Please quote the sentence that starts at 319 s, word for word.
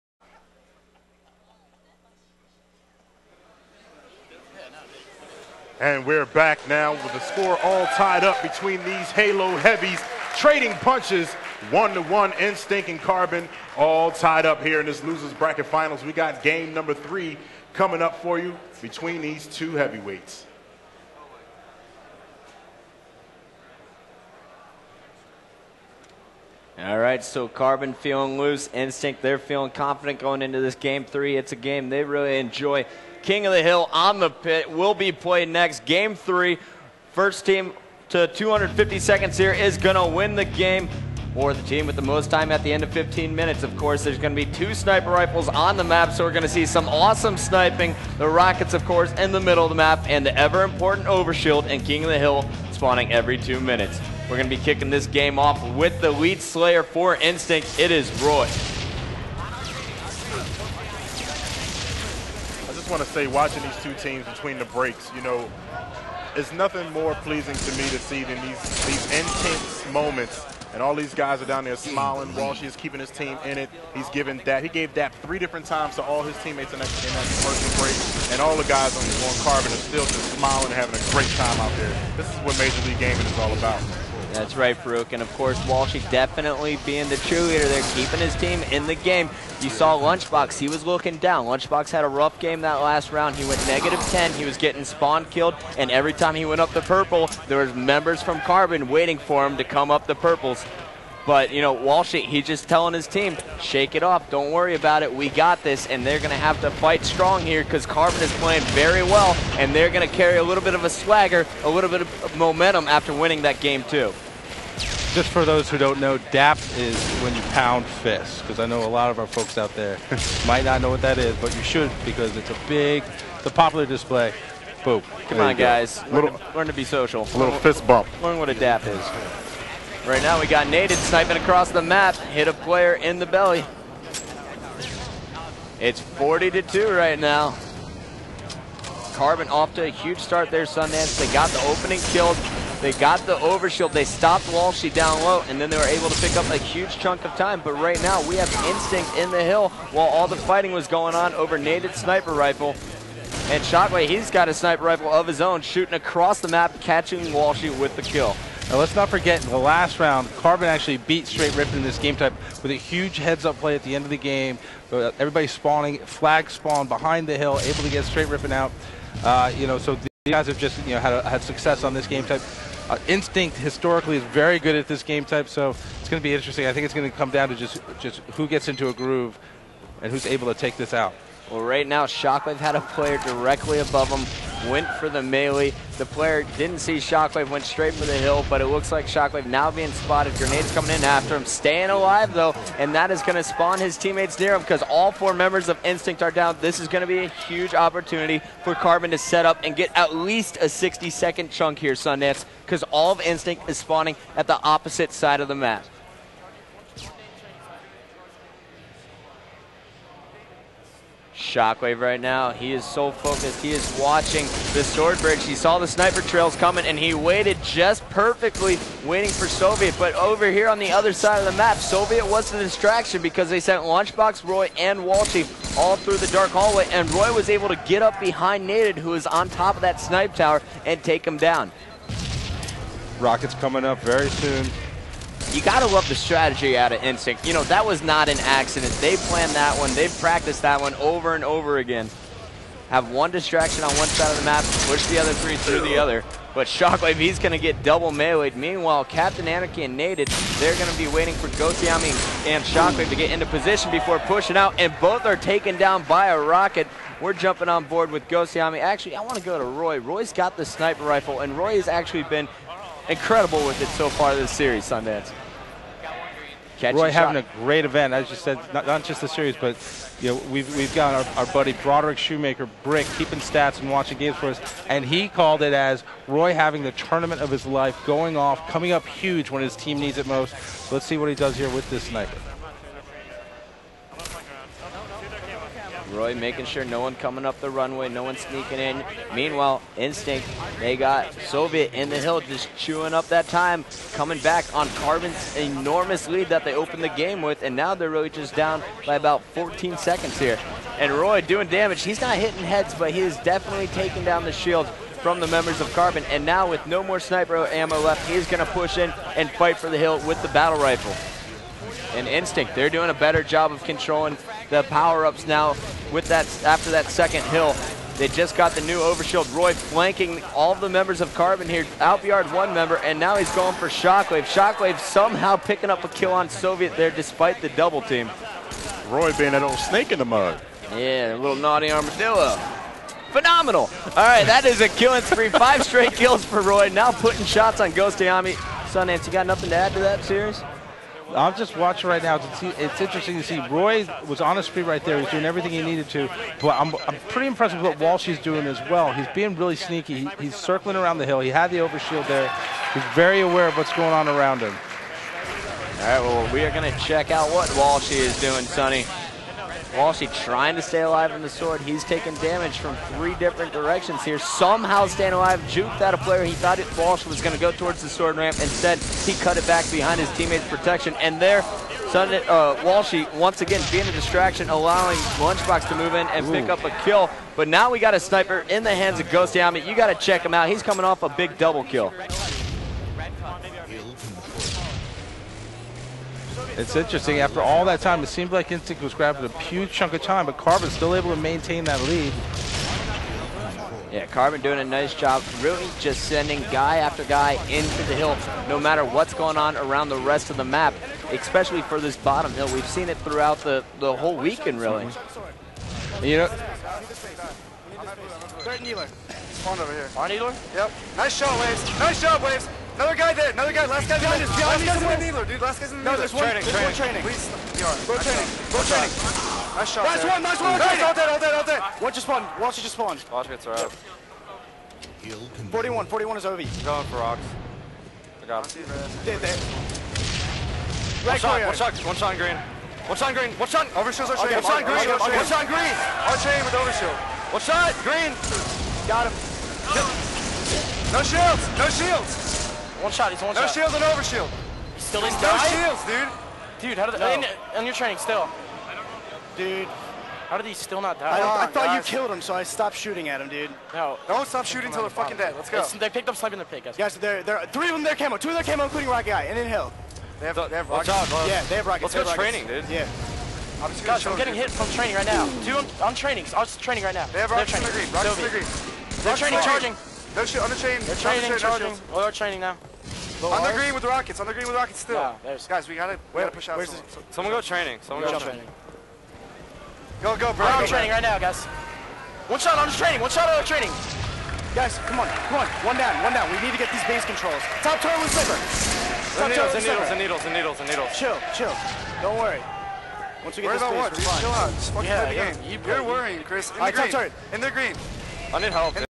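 Roy flanking all the members of Carbon here.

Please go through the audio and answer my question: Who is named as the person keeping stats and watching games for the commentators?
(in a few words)
Broderick Shoemaker.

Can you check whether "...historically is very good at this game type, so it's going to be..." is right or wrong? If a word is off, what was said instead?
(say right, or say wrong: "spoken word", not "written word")
right.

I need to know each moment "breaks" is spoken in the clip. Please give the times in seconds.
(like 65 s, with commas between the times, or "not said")
64 s, 77 s.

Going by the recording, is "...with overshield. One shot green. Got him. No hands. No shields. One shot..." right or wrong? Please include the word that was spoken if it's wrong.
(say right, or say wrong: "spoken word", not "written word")
wrong: "shields", not "hands".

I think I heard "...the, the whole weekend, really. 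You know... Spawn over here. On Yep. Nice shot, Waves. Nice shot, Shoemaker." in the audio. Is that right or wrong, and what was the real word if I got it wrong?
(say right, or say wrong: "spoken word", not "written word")
wrong: "Waves", not "Shoemaker".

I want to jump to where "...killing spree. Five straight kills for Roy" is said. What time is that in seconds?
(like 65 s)
334 s.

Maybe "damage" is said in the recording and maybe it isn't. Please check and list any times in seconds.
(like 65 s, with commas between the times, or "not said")
301 s, 362 s.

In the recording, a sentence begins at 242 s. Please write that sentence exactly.
Have one distraction on one side of the map, push the other three through the other.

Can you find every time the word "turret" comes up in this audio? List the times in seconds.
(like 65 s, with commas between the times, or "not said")
487 s, 497 s.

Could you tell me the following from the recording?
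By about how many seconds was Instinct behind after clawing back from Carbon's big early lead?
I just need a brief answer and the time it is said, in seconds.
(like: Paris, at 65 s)
14, at 299 s.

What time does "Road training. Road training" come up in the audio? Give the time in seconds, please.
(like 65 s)
418 s.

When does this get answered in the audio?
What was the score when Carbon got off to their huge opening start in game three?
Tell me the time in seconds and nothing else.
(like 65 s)
136 s.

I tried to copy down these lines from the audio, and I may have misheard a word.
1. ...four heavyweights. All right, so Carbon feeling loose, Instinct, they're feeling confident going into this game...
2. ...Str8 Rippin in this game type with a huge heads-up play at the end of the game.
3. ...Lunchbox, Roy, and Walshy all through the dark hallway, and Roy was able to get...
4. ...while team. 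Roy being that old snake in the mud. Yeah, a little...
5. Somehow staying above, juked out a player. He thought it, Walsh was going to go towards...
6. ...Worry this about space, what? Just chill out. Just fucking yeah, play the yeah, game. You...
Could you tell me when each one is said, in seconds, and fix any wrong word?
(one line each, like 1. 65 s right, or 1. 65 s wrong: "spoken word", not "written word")
1. 19 s wrong: "two", not "four"
2. 161 s right
3. 223 s right
4. 327 s wrong: "double", not "while"
5. 364 s wrong: "alive", not "above"
6. 493 s right.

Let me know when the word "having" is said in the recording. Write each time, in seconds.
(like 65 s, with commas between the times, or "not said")
80 s, 267 s, 276 s.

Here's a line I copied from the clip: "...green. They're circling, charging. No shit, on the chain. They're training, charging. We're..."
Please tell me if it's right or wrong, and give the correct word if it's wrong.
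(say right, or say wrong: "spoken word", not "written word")
wrong: "training", not "circling".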